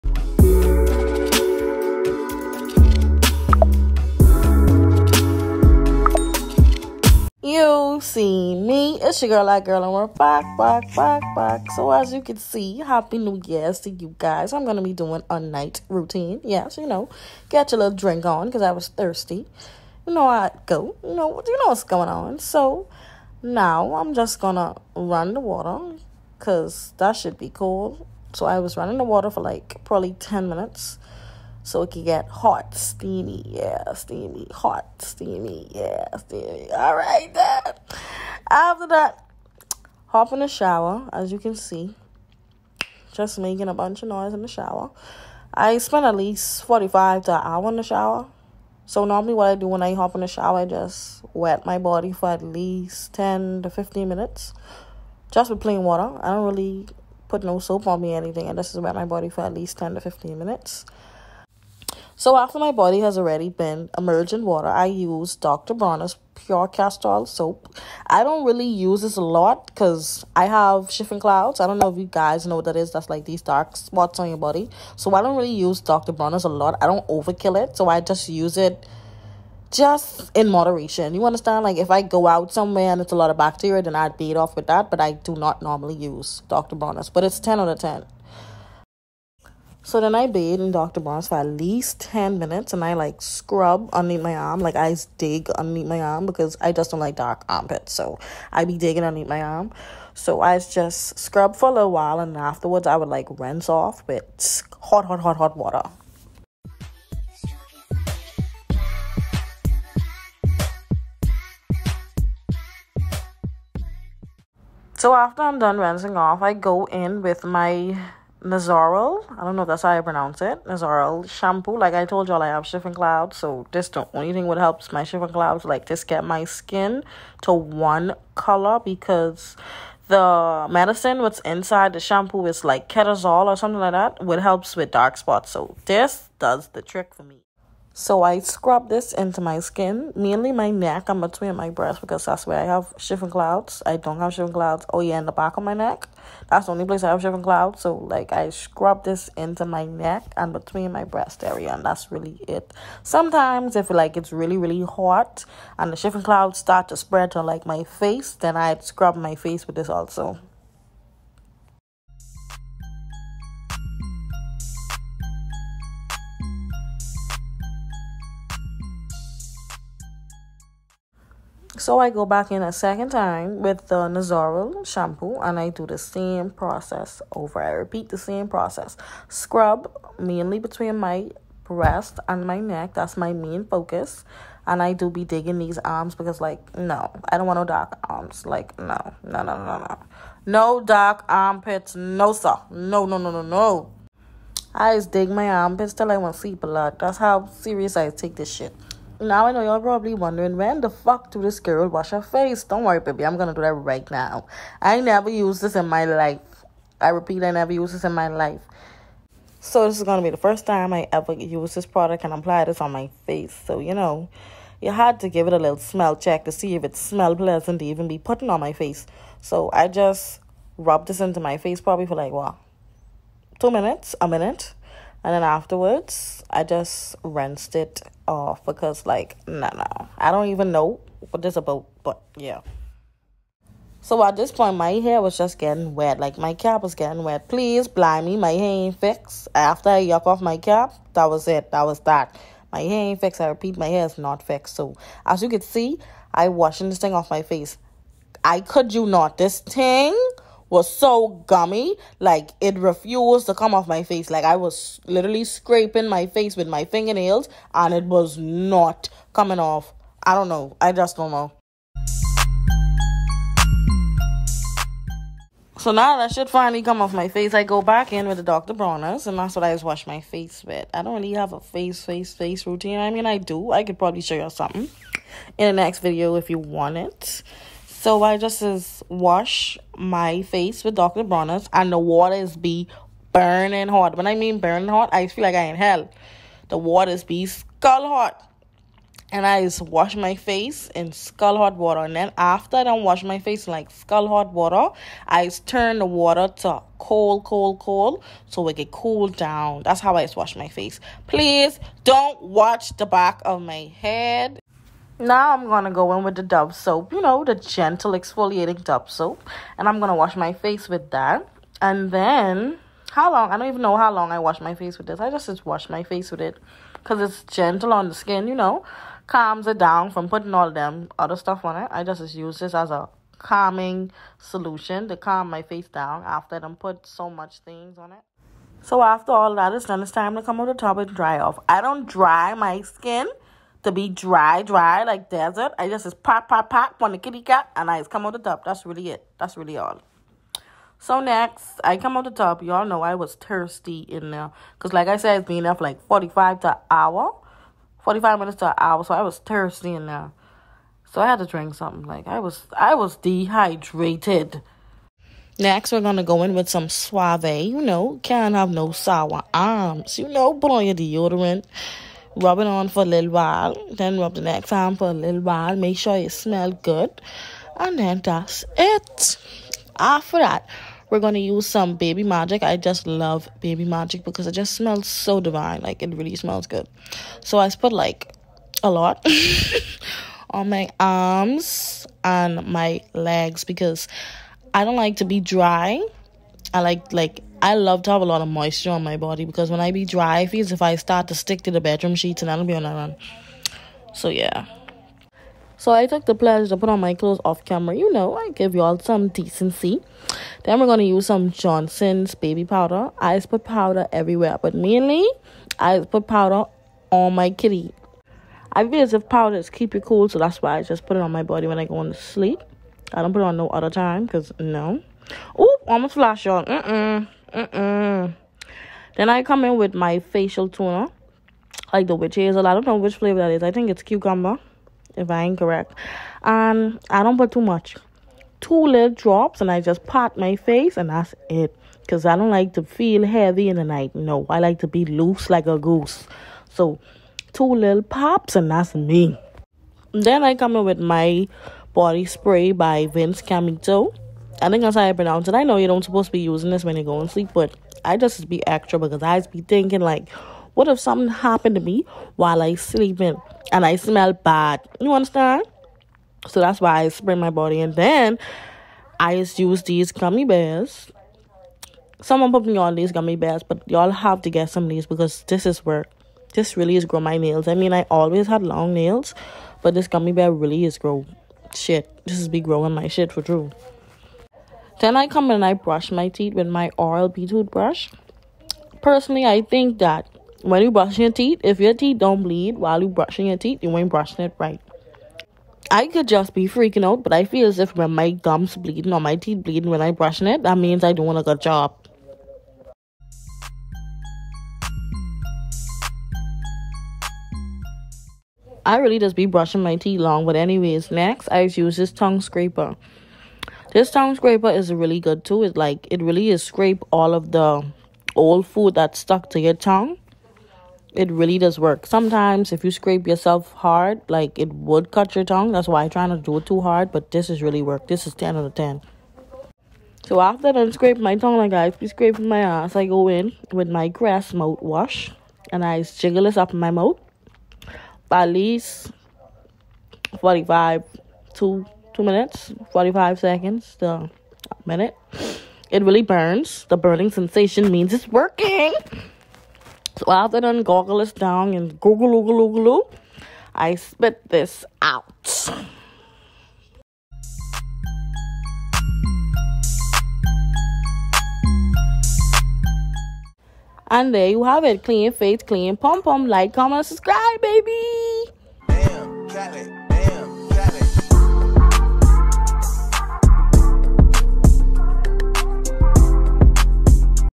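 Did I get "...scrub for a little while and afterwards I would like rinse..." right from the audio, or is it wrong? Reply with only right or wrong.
right.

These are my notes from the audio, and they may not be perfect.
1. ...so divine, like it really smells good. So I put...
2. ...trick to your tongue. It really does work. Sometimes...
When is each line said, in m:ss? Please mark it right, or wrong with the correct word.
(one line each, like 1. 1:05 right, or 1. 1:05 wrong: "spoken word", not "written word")
1. 6:15 right
2. 8:29 wrong: "stuck", not "trick".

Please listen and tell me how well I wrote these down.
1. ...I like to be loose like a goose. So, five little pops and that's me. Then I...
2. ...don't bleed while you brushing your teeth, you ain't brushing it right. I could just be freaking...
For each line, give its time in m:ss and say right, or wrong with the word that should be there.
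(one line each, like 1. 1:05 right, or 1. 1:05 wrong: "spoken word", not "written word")
1. 7:14 wrong: "two", not "five"
2. 8:02 right.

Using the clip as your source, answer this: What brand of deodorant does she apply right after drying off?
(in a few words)
Suave.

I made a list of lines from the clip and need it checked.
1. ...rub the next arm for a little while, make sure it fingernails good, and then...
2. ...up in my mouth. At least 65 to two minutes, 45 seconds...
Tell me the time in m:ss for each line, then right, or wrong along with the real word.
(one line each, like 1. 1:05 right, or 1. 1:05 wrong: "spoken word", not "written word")
1. 6:04 wrong: "smells", not "fingernails"
2. 8:46 wrong: "45", not "65".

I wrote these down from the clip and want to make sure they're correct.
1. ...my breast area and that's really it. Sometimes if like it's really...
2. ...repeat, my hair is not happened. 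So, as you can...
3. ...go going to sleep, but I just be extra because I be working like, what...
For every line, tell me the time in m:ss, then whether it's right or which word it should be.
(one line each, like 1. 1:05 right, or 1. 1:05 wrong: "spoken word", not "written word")
1. 2:30 right
2. 4:03 wrong: "fixed", not "happened"
3. 7:27 wrong: "thinking", not "working".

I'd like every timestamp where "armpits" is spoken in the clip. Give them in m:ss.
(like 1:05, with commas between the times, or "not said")
1:37, 3:11, 3:15.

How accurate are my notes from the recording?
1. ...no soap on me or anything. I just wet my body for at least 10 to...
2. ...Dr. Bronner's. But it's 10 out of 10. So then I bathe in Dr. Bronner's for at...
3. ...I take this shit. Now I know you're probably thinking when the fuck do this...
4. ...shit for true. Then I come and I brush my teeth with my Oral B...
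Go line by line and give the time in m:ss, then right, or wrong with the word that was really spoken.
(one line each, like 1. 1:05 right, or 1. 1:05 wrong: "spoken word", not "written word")
1. 0:57 right
2. 1:26 right
3. 3:17 wrong: "wondering", not "thinking"
4. 7:53 right.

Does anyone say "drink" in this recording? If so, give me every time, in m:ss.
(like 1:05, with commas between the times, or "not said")
0:17, 5:51.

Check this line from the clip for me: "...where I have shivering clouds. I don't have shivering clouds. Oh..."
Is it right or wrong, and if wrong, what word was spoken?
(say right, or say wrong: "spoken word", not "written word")
right.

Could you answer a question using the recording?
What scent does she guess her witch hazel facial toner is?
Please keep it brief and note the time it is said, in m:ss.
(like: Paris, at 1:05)
cucumber, at 7:04.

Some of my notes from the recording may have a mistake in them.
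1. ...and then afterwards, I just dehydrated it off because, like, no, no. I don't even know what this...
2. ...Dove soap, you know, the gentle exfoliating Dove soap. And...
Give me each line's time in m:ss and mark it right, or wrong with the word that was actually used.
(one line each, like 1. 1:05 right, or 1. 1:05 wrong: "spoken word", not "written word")
1. 3:45 wrong: "rinsed", not "dehydrated"
2. 5:06 right.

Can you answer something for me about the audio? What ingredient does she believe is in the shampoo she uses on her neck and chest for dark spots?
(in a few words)
ketazol.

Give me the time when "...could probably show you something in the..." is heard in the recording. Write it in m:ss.
4:33.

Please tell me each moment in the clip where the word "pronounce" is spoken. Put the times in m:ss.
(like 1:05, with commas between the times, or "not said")
2:00, 7:25.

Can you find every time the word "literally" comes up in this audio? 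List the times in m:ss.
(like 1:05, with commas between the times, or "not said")
4:15.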